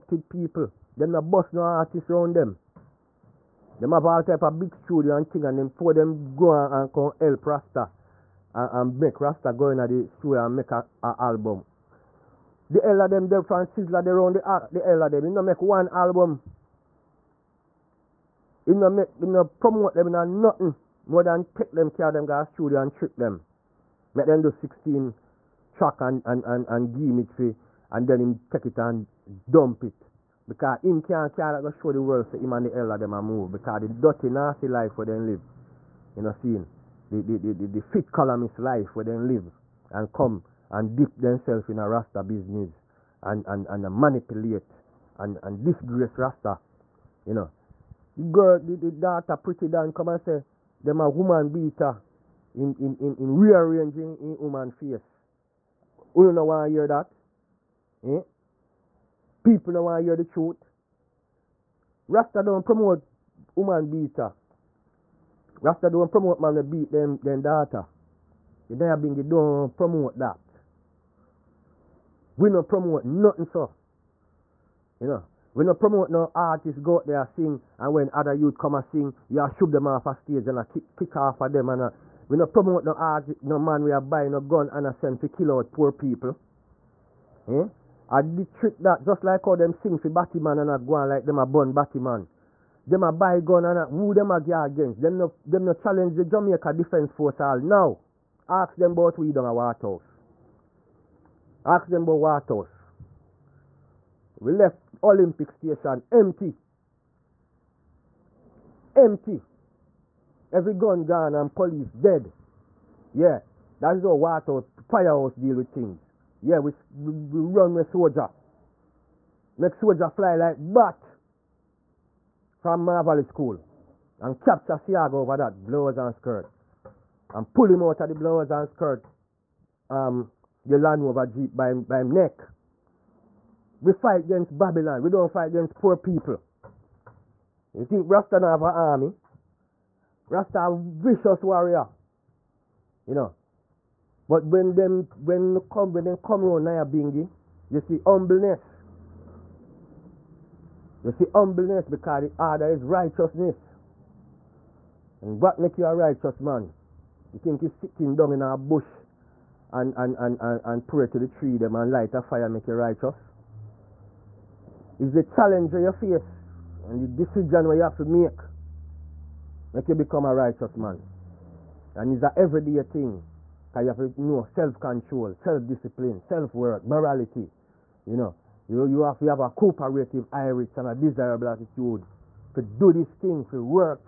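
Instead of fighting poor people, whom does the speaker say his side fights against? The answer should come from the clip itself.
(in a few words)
Babylon.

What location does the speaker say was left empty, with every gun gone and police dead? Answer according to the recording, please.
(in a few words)
Olympic Station.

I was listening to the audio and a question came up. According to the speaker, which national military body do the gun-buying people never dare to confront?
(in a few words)
Jamaica Defence Force.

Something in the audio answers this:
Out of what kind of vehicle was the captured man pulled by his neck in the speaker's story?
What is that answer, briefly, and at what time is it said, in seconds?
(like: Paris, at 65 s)
Land Rover Jeep, at 130 s.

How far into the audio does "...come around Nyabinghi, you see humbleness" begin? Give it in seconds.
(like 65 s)
146 s.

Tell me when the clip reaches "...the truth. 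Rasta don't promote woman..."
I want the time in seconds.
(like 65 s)
60 s.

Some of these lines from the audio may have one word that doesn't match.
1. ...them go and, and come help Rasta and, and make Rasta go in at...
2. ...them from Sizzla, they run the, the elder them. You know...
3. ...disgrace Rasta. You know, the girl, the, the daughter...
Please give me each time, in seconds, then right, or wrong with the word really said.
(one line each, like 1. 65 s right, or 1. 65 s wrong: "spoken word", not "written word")
1. 5 s right
2. 13 s right
3. 45 s right.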